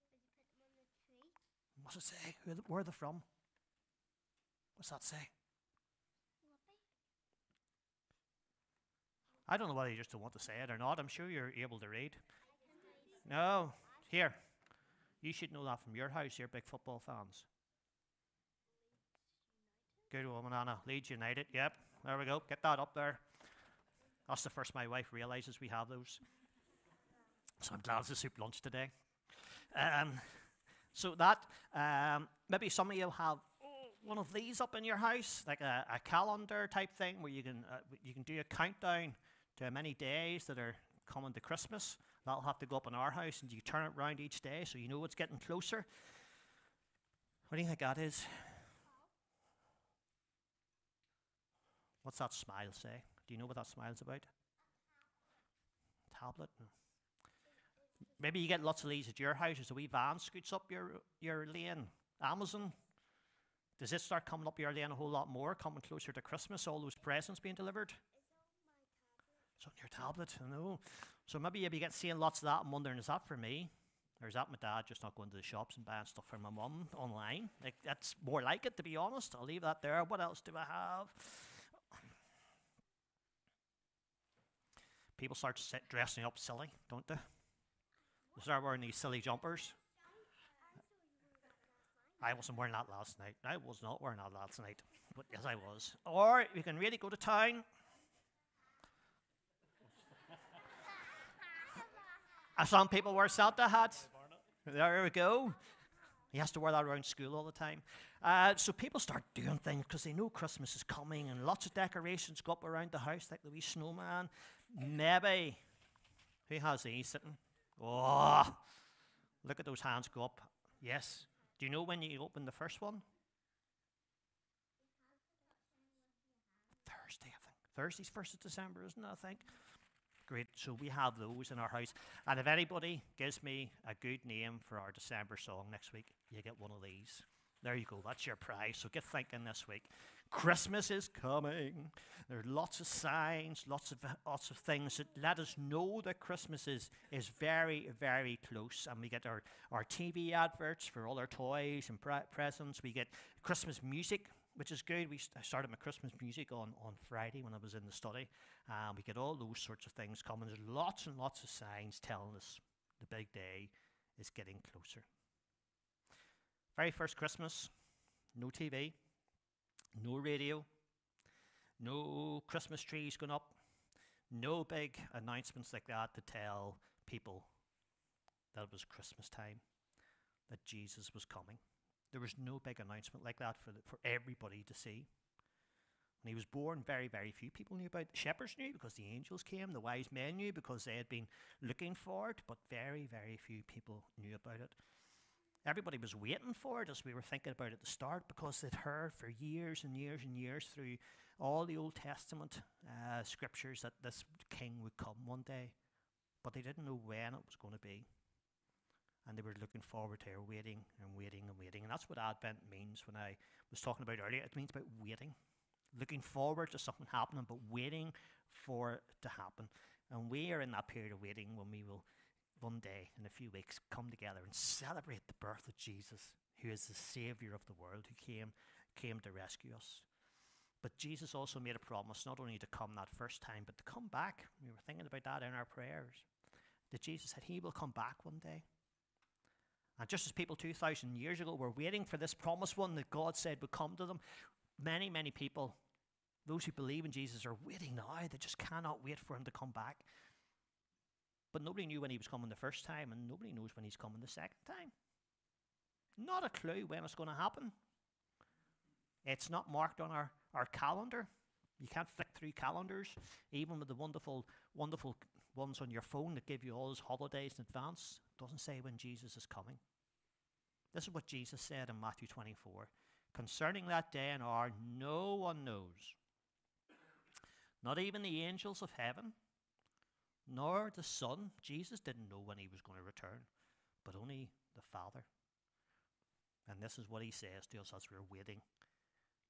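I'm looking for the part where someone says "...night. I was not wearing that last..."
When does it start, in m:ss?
1:33.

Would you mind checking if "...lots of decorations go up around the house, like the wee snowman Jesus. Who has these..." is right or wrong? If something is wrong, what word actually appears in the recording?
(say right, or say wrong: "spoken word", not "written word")
wrong: "Maybe", not "Jesus".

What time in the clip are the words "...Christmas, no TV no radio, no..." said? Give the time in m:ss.
2:47.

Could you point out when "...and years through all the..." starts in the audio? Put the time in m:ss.
3:20.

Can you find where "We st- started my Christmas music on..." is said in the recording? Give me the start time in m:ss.
2:35.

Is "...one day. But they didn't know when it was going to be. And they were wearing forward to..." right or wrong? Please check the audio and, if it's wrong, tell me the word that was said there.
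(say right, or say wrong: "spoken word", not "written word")
wrong: "looking", not "wearing".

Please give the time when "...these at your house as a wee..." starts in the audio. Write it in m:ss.
0:58.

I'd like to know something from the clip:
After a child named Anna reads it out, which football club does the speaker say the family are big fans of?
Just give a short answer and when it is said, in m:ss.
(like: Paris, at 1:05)
Leeds United, at 0:20.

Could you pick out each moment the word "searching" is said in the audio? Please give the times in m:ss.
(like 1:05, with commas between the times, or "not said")
not said.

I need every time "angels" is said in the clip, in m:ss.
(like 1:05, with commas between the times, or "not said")
3:09, 4:38.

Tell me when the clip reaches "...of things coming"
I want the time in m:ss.
2:39.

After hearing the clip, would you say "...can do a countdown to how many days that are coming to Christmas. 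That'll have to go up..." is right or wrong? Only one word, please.
right.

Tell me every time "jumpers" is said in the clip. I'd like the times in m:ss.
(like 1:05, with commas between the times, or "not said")
1:29.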